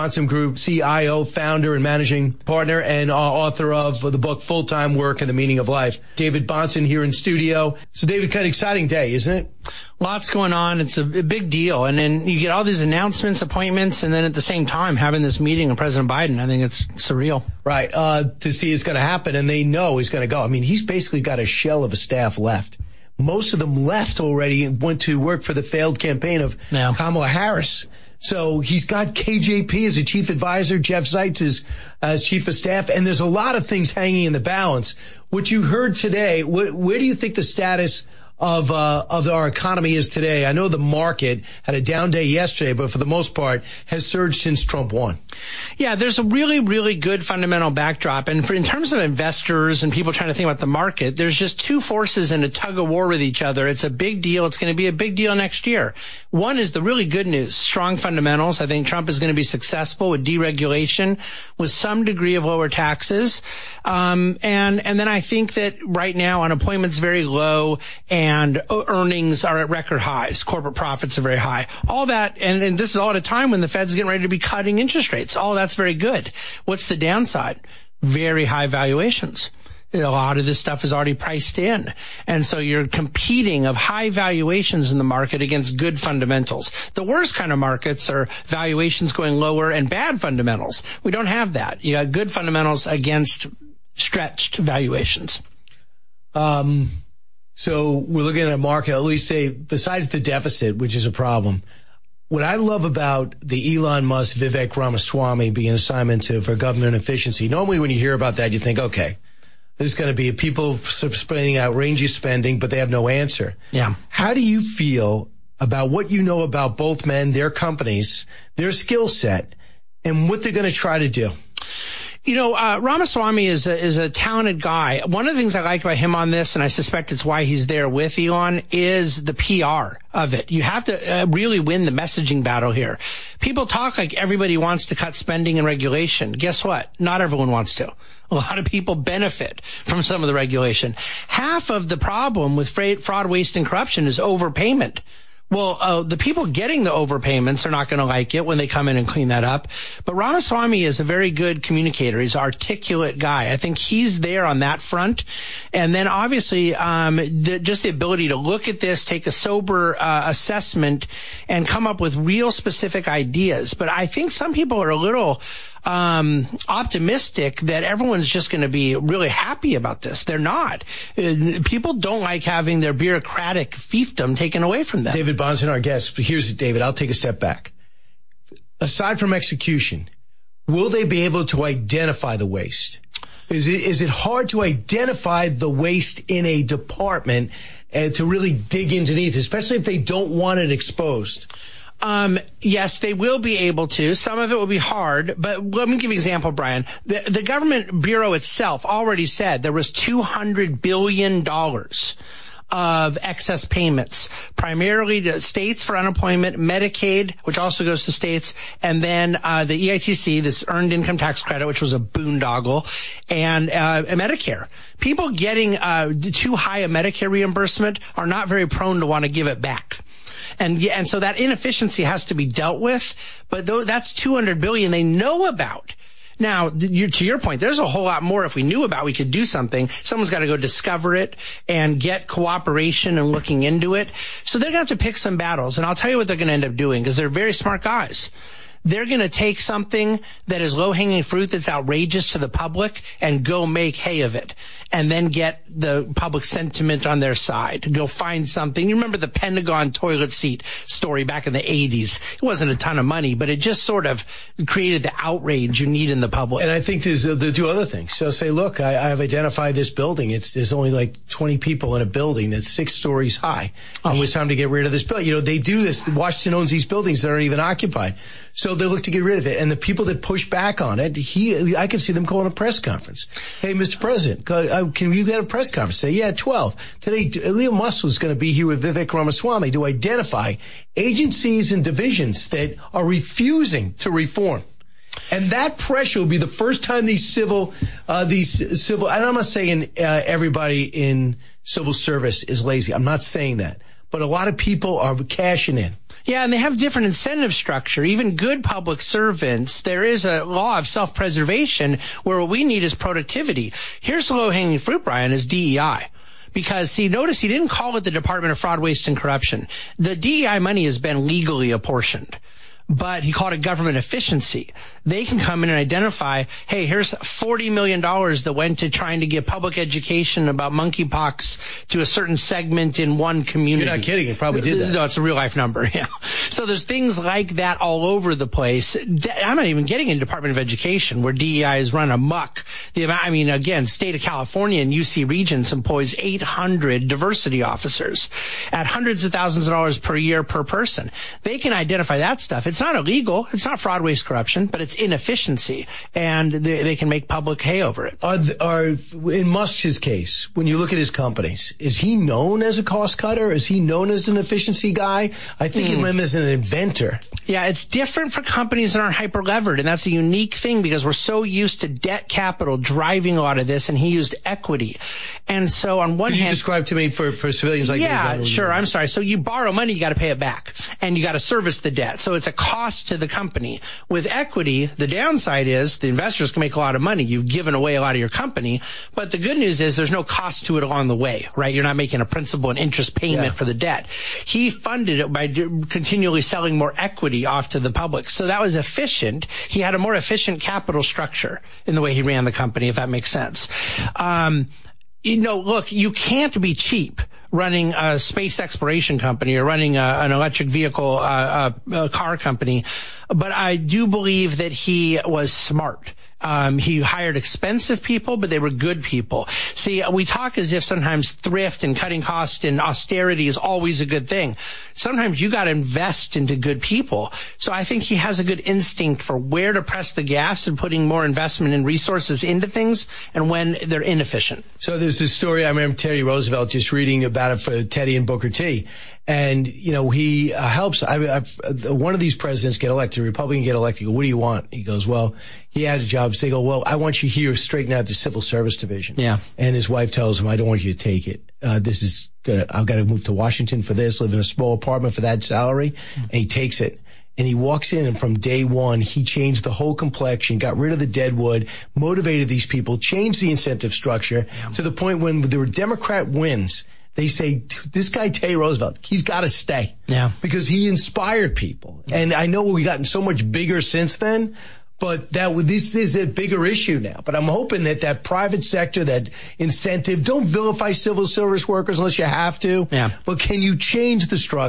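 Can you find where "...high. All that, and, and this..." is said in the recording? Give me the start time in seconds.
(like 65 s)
71 s.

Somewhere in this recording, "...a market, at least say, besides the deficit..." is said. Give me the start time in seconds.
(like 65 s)
98 s.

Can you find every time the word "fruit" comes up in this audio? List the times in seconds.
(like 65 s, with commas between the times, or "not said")
241 s, 304 s.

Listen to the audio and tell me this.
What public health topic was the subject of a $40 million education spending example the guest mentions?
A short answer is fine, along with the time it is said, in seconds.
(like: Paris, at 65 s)
Monkeypox, at 320 s.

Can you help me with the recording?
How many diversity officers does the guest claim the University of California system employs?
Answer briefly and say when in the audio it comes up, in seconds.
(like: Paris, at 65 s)
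800, at 336 s.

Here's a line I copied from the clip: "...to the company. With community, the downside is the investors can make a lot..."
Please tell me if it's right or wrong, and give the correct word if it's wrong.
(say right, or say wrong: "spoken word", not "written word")
wrong: "equity", not "community".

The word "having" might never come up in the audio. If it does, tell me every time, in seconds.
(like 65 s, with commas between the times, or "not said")
14 s, 172 s.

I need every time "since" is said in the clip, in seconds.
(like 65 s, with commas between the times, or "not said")
44 s, 463 s.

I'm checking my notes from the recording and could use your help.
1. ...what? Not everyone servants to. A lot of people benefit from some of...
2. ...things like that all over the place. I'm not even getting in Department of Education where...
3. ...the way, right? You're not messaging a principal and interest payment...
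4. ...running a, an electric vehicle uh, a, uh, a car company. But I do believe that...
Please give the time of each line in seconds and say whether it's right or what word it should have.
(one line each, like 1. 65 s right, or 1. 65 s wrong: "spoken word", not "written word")
1. 136 s wrong: "wants", not "servants"
2. 326 s right
3. 381 s wrong: "making", not "messaging"
4. 399 s right.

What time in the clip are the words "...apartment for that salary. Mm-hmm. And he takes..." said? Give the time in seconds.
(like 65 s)
444 s.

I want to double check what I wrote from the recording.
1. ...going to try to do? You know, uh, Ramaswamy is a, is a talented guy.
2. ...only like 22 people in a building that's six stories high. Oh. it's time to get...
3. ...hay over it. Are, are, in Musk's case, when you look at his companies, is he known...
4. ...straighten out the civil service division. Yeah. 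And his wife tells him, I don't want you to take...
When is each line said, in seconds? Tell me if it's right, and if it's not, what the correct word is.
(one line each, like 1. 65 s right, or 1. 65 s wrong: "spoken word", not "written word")
1. 120 s right
2. 260 s wrong: "20", not "22"
3. 347 s right
4. 437 s right.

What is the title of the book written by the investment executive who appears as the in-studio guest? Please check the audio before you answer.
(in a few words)
Full Time Work and the Meaning of Life.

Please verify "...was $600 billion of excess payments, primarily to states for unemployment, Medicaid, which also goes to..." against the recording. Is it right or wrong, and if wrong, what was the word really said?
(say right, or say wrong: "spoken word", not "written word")
wrong: "200", not "600".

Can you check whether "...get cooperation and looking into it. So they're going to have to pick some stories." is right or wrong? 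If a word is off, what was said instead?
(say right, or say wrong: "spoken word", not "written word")
wrong: "battles", not "stories".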